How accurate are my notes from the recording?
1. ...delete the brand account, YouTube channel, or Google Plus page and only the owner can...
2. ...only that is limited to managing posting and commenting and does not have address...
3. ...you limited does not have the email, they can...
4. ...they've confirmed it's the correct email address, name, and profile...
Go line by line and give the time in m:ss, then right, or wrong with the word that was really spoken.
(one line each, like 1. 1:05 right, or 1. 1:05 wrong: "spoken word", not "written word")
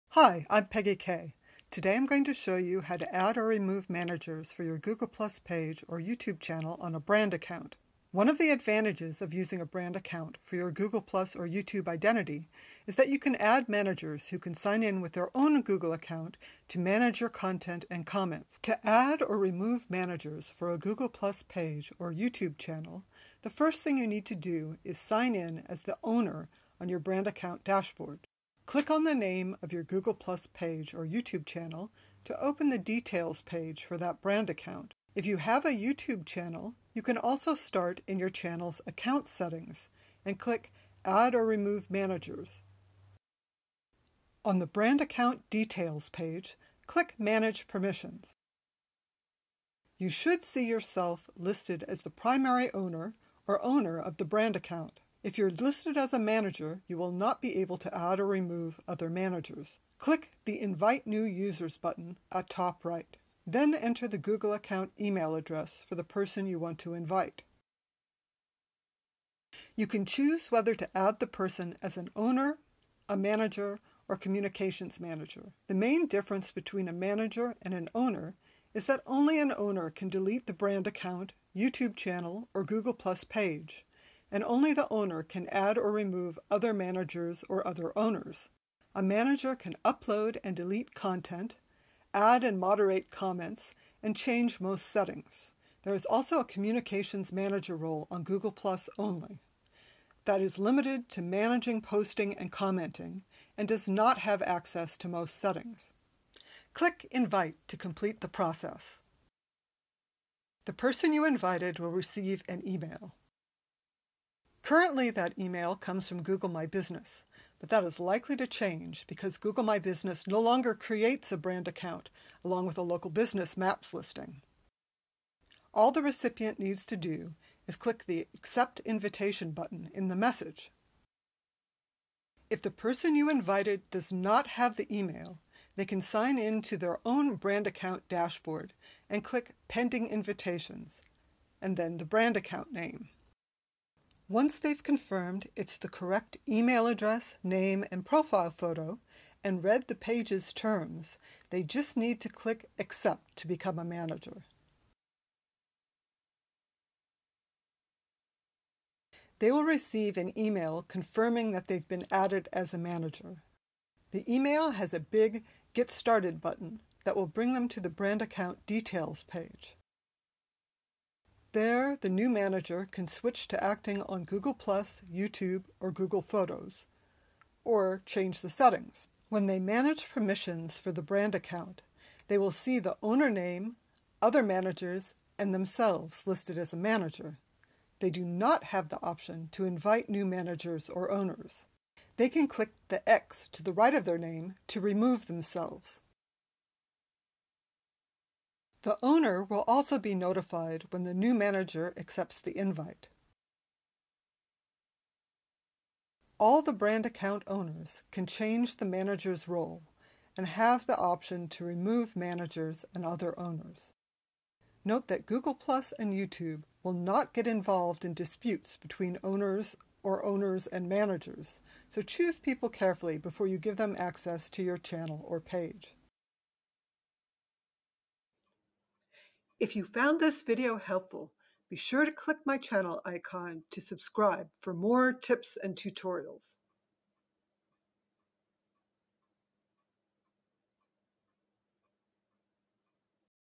1. 1:20 right
2. 1:38 wrong: "access", not "address"
3. 2:13 wrong: "invited", not "limited"
4. 2:24 right.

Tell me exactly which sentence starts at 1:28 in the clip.
A manager can upload and delete content, add and moderate comments, and change most settings.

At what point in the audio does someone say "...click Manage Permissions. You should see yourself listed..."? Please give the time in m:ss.
0:46.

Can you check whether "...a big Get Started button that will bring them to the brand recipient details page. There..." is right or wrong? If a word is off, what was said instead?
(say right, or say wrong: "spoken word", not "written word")
wrong: "account", not "recipient".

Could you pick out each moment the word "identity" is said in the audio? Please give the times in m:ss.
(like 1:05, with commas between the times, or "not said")
0:11.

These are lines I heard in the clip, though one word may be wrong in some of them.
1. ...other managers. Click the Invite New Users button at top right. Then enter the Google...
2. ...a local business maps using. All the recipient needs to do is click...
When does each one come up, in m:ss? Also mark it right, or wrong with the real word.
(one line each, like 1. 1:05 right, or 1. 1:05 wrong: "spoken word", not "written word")
1. 0:58 right
2. 2:02 wrong: "listing", not "using".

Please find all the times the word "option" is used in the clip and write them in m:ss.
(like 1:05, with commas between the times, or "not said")
3:09, 3:30.